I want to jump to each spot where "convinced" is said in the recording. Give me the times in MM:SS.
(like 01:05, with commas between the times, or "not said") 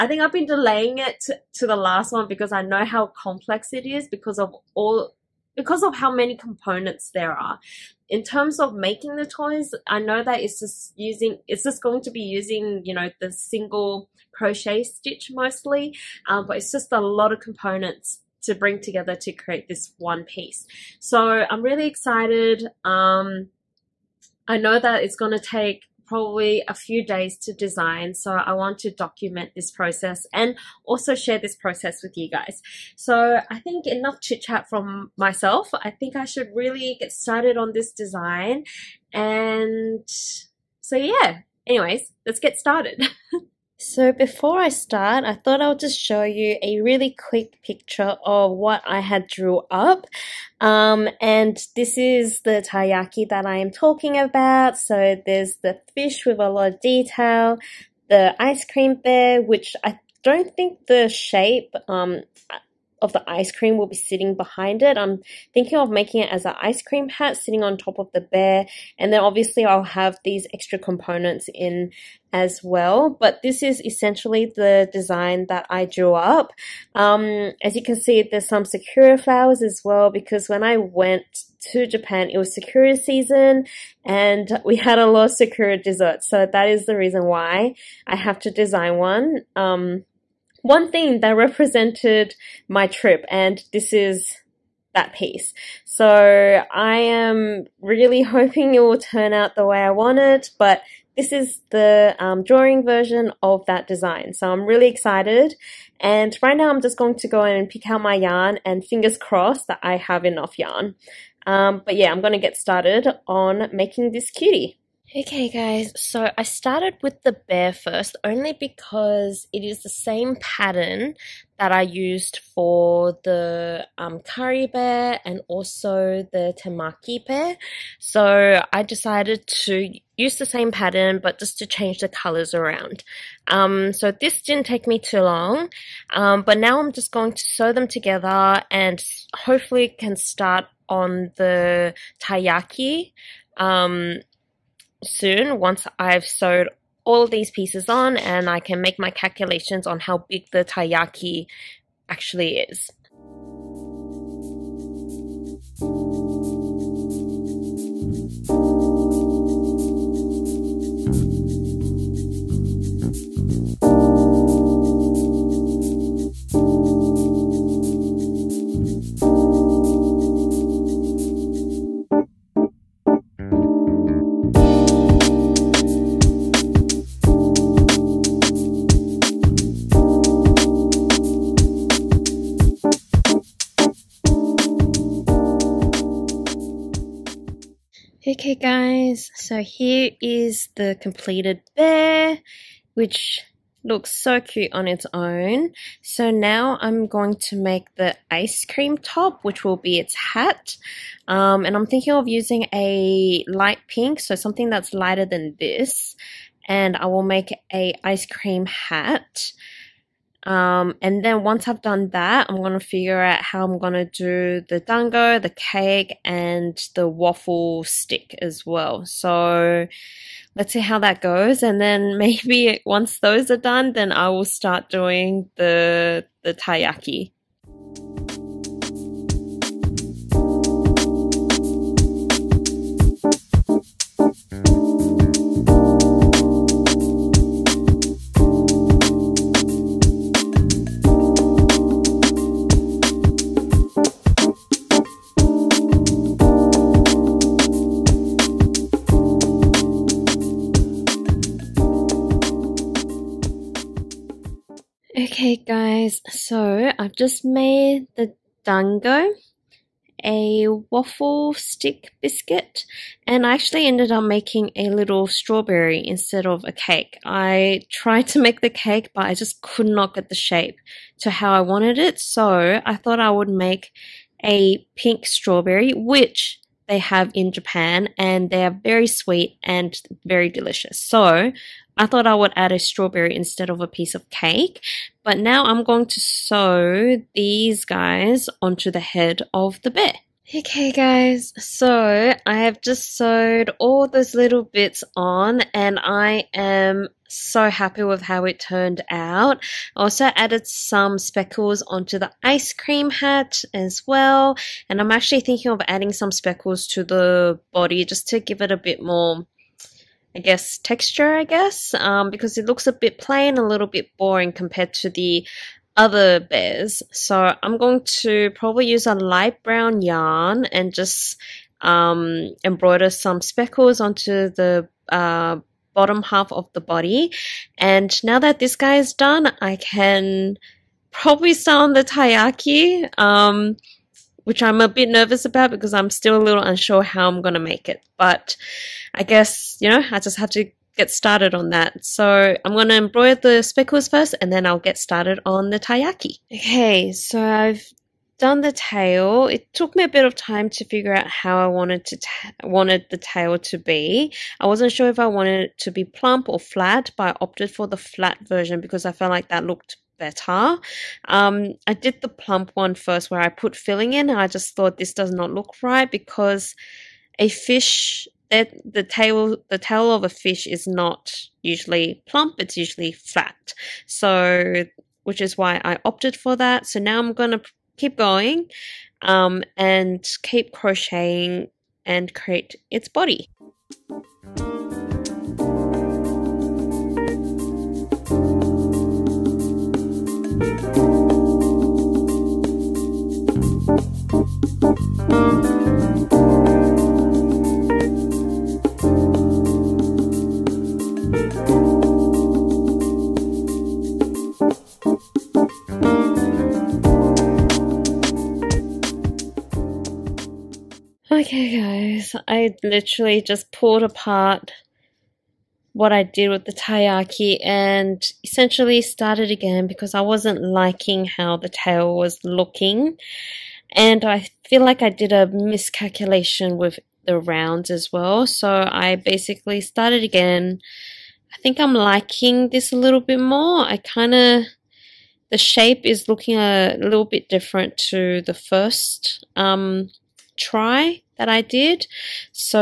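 not said.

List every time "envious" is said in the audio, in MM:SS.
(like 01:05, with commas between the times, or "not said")
not said.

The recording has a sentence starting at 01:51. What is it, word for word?
Um, but yeah, I'm going to get started on making this cutie.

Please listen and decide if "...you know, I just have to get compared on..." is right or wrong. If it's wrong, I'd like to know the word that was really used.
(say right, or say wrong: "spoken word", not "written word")
wrong: "started", not "compared".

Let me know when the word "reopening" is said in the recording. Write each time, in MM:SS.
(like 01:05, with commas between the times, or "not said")
not said.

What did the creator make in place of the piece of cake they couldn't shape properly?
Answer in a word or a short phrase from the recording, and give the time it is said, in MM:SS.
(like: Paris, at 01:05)
pink strawberry, at 04:34.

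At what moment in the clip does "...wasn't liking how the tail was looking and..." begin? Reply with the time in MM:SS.
07:00.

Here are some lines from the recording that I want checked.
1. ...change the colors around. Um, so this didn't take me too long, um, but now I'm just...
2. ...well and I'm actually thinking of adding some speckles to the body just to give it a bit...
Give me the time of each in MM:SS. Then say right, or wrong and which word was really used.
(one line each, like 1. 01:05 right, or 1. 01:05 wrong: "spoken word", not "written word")
1. 02:11 right
2. 05:04 right.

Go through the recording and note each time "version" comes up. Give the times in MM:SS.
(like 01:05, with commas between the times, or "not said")
01:42, 05:58.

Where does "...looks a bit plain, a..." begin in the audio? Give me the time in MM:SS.
05:12.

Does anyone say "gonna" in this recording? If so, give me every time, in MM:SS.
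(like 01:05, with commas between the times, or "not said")
06:17.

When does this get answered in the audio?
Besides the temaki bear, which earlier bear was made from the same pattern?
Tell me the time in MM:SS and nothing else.
02:04.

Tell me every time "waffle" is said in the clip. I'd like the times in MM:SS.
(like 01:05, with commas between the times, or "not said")
03:37, 04:20.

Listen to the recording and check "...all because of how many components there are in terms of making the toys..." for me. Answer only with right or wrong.
right.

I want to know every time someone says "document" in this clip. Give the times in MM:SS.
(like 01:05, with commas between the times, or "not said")
00:28.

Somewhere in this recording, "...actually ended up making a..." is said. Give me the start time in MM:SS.
04:23.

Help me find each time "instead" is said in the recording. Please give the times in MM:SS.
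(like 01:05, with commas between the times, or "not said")
04:26, 04:43.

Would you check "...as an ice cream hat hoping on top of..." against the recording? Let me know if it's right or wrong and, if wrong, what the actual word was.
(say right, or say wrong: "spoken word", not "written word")
wrong: "sitting", not "hoping".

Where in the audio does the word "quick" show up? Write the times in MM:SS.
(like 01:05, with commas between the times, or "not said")
00:47.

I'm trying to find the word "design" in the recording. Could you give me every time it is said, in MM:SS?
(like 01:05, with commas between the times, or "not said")
00:27, 00:37, 01:14, 01:28, 01:43.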